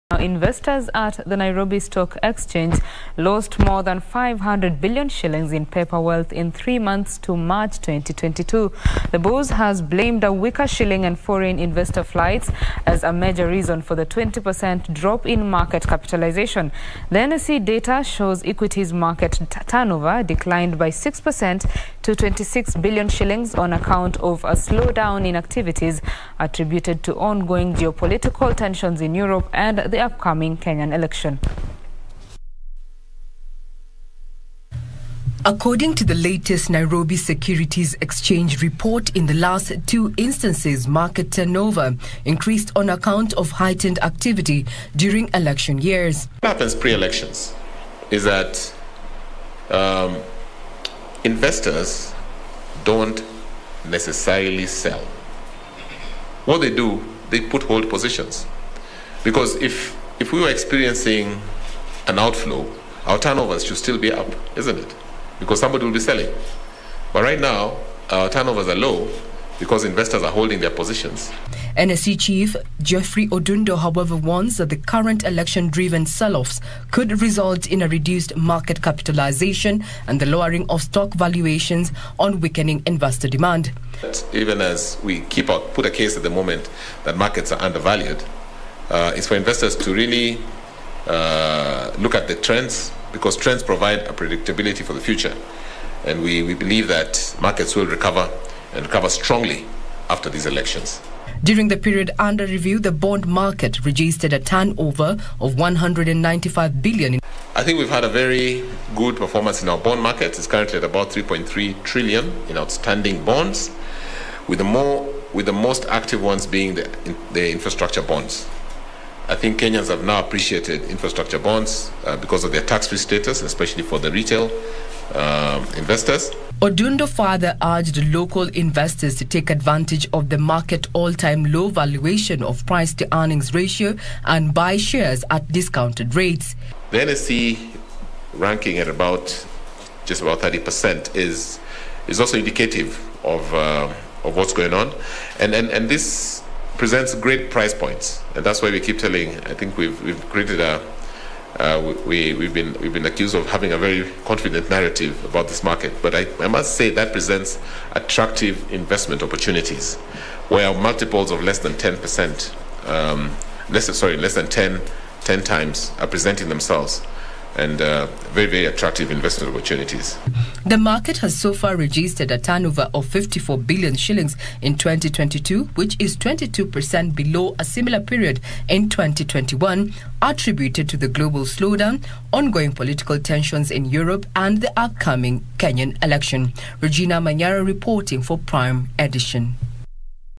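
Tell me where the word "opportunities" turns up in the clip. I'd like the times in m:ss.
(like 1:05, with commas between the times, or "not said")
2:39, 2:49.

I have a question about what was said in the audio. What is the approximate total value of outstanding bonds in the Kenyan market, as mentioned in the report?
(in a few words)
3.3 trillion.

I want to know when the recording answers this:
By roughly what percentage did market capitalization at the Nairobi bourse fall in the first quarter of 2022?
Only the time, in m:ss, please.
0:14.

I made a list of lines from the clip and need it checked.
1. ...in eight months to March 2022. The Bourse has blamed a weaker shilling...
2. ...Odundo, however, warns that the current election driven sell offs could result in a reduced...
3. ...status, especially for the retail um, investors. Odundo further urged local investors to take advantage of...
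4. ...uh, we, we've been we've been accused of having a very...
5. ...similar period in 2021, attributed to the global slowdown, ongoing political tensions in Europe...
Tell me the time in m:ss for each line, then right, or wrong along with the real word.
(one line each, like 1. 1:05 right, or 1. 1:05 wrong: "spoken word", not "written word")
1. 0:06 wrong: "three", not "eight"
2. 1:13 right
3. 2:02 right
4. 2:31 right
5. 2:57 right.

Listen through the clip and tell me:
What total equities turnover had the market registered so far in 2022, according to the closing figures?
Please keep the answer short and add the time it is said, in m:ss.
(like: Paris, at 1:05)
54 billion shillings, at 2:53.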